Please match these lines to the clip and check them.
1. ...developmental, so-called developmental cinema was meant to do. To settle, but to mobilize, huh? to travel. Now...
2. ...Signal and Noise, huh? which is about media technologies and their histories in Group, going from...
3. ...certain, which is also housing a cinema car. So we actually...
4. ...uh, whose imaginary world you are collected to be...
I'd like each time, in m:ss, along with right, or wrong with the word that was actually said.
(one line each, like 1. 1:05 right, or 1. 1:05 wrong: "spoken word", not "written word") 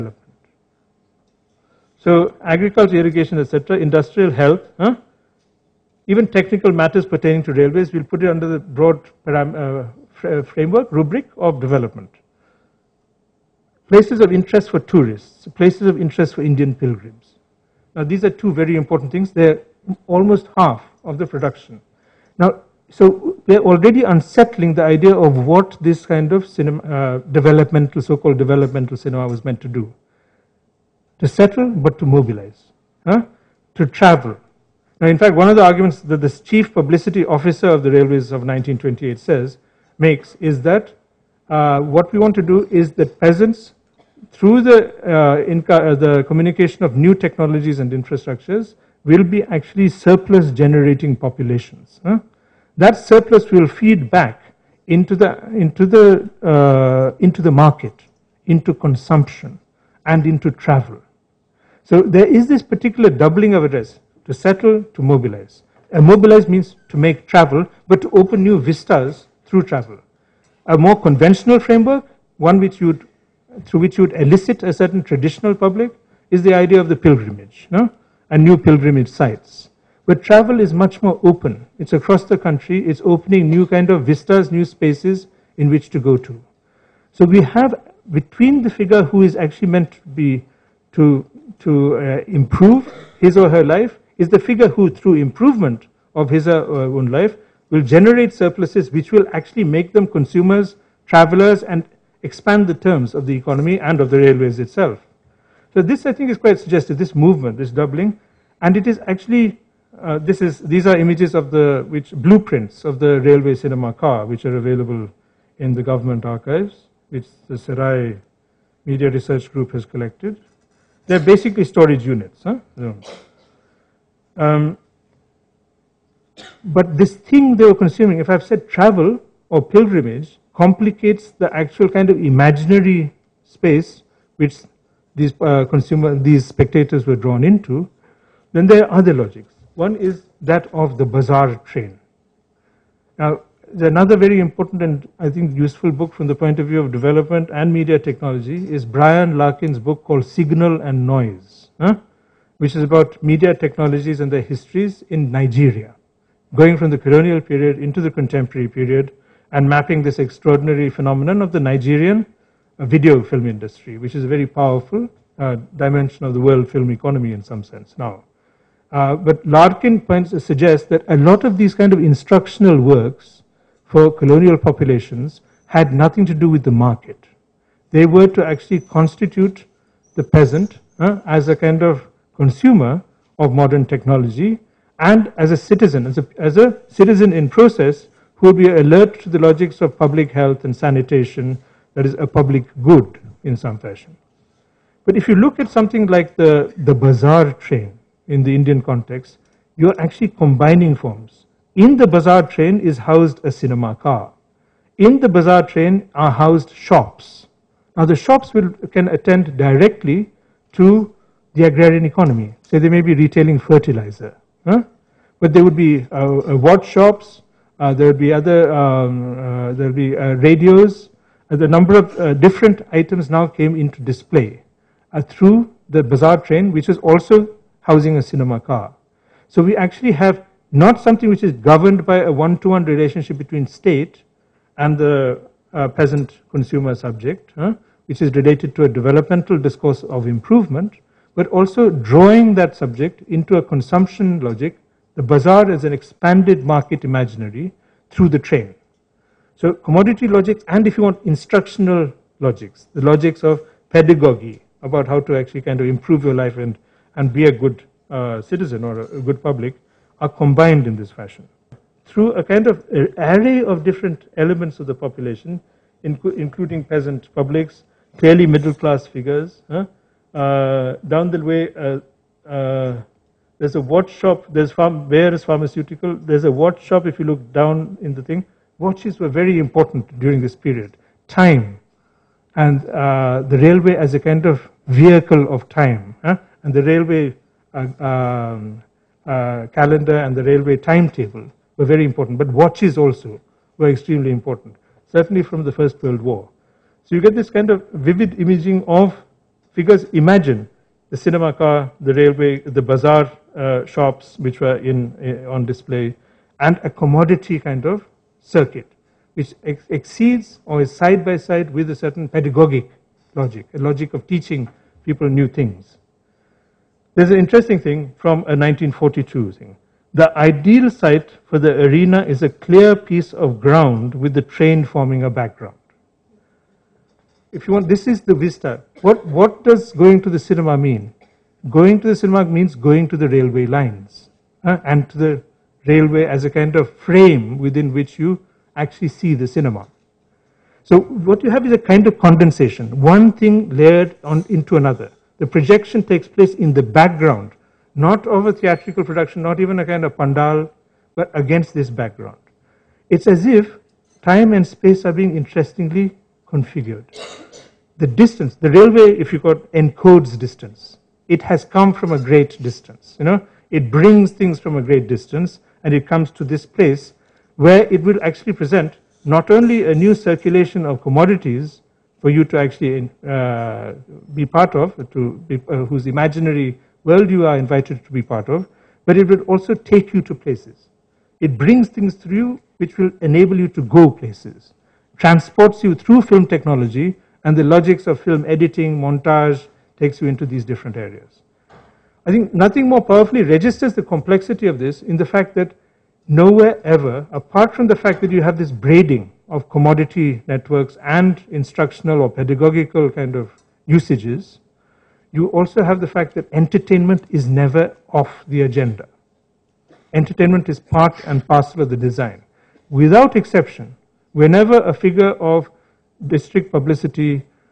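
1. 0:27 right
2. 2:30 wrong: "Nigeria", not "Group"
3. 3:46 wrong: "train", not "certain"
4. 6:15 wrong: "invited", not "collected".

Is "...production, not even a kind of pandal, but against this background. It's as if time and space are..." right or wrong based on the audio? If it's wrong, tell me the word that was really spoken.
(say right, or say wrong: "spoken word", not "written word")
right.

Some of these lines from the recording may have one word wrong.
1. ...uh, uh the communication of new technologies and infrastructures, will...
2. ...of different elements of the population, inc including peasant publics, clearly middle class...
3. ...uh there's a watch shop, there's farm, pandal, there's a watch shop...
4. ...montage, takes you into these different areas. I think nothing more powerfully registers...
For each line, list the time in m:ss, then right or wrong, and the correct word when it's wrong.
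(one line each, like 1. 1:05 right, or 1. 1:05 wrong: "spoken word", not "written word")
1. 0:45 right
2. 4:23 right
3. 4:32 wrong: "pharmaceutical", not "pandal"
4. 6:29 right.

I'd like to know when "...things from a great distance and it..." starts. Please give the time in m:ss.
6:04.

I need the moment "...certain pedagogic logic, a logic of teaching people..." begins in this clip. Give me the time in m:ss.
5:11.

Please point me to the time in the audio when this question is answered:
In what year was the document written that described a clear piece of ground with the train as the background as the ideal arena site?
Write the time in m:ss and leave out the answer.
5:18.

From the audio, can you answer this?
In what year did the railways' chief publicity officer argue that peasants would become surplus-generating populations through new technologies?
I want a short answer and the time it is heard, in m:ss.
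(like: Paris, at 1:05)
1928, at 0:38.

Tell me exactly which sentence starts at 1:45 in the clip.
So this, I think, is quite suggestive.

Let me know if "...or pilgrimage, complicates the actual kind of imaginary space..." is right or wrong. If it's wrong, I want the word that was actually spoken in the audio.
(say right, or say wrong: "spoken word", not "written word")
right.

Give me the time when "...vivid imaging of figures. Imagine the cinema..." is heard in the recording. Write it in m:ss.
4:57.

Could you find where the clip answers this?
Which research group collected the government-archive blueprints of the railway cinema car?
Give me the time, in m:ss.
1:57.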